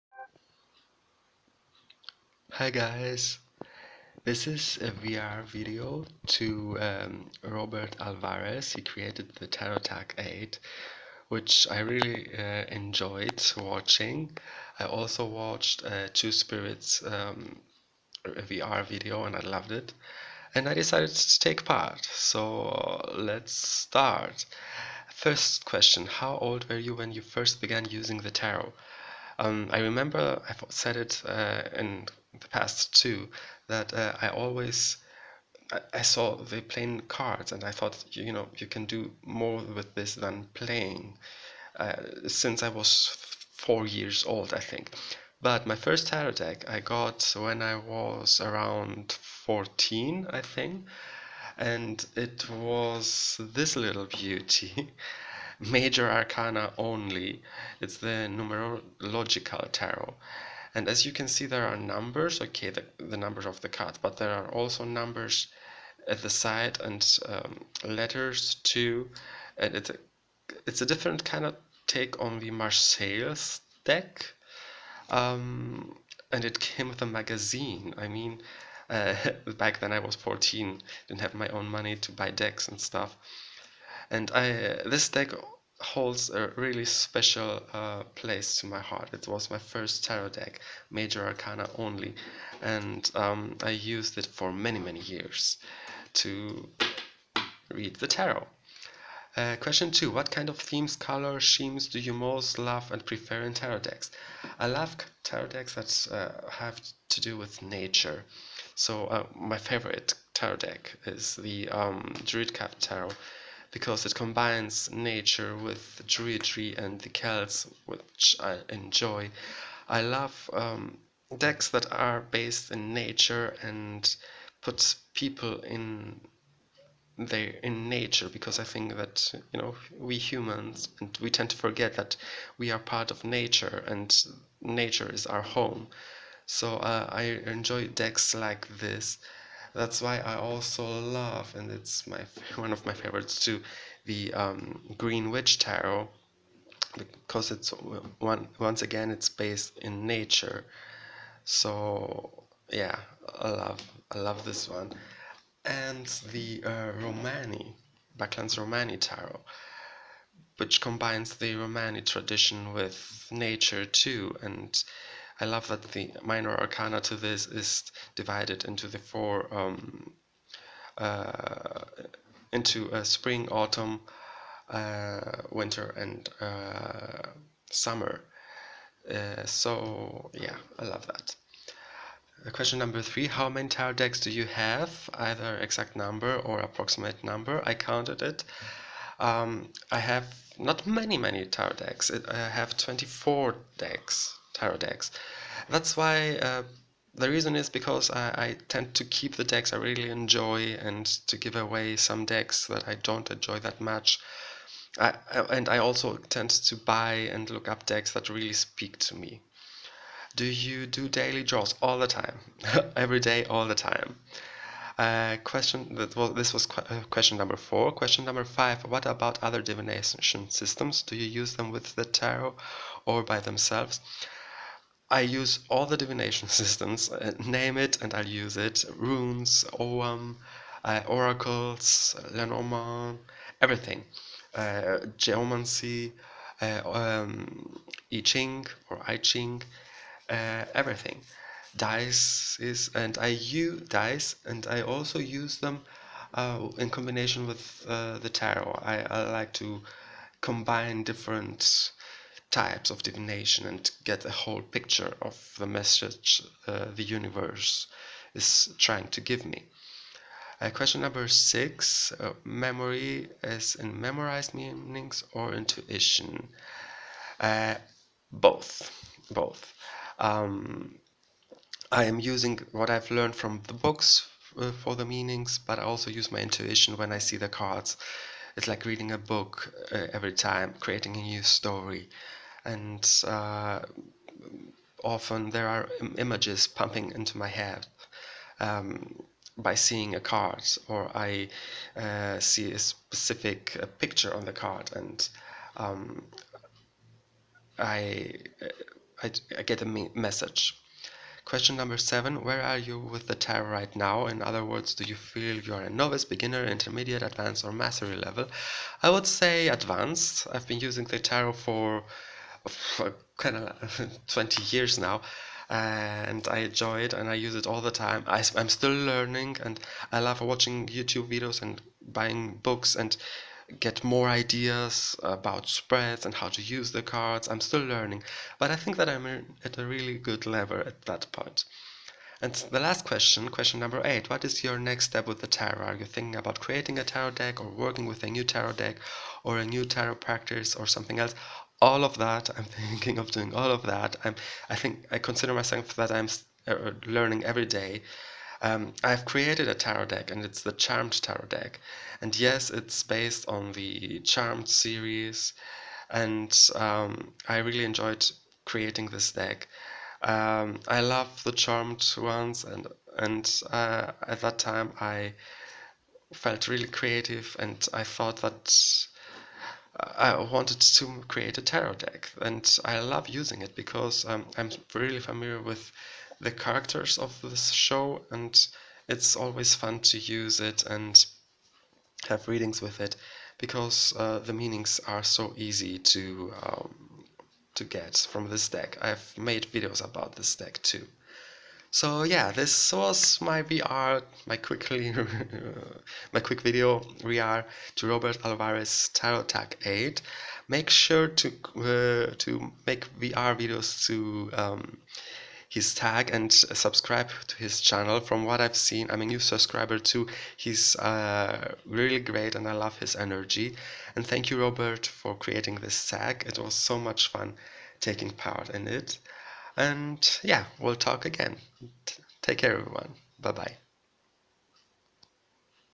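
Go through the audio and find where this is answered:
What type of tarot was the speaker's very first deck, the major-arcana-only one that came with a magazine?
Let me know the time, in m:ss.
0:58.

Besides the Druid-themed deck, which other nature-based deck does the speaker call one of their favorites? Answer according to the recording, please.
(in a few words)
Green Witch Tarot.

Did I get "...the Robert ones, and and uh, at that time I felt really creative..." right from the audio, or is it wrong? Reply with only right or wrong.
wrong.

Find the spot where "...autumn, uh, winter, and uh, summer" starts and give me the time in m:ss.
2:53.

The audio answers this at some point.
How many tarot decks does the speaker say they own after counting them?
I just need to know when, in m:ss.
3:12.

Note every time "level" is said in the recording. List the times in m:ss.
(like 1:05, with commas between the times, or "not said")
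5:08, 5:30.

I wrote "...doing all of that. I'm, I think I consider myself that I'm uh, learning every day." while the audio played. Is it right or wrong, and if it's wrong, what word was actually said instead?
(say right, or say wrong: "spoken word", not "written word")
right.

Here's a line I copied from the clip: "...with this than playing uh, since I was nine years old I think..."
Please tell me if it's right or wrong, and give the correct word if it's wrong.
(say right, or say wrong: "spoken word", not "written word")
wrong: "four", not "nine".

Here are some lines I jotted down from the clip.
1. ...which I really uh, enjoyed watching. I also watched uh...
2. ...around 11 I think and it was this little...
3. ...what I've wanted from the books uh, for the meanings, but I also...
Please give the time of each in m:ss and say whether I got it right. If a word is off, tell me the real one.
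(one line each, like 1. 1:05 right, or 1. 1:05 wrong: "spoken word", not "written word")
1. 0:11 right
2. 0:48 wrong: "14", not "11"
3. 4:32 wrong: "learned", not "wanted".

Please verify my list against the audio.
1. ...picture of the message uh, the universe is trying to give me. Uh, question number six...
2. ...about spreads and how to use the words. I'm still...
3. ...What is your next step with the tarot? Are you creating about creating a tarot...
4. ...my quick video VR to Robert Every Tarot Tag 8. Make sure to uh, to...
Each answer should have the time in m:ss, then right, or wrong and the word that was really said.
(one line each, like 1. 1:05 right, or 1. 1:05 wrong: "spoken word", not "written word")
1. 4:14 right
2. 5:25 wrong: "cards", not "words"
3. 5:34 wrong: "thinking", not "creating"
4. 6:36 wrong: "Alvarez", not "Every".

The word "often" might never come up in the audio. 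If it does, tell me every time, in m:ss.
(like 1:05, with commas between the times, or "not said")
4:45.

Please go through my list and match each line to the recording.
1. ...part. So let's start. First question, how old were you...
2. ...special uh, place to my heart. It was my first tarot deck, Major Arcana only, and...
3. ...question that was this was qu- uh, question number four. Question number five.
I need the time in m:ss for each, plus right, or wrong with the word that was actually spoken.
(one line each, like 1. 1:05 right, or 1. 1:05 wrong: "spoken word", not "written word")
1. 0:21 right
2. 1:26 right
3. 3:35 right.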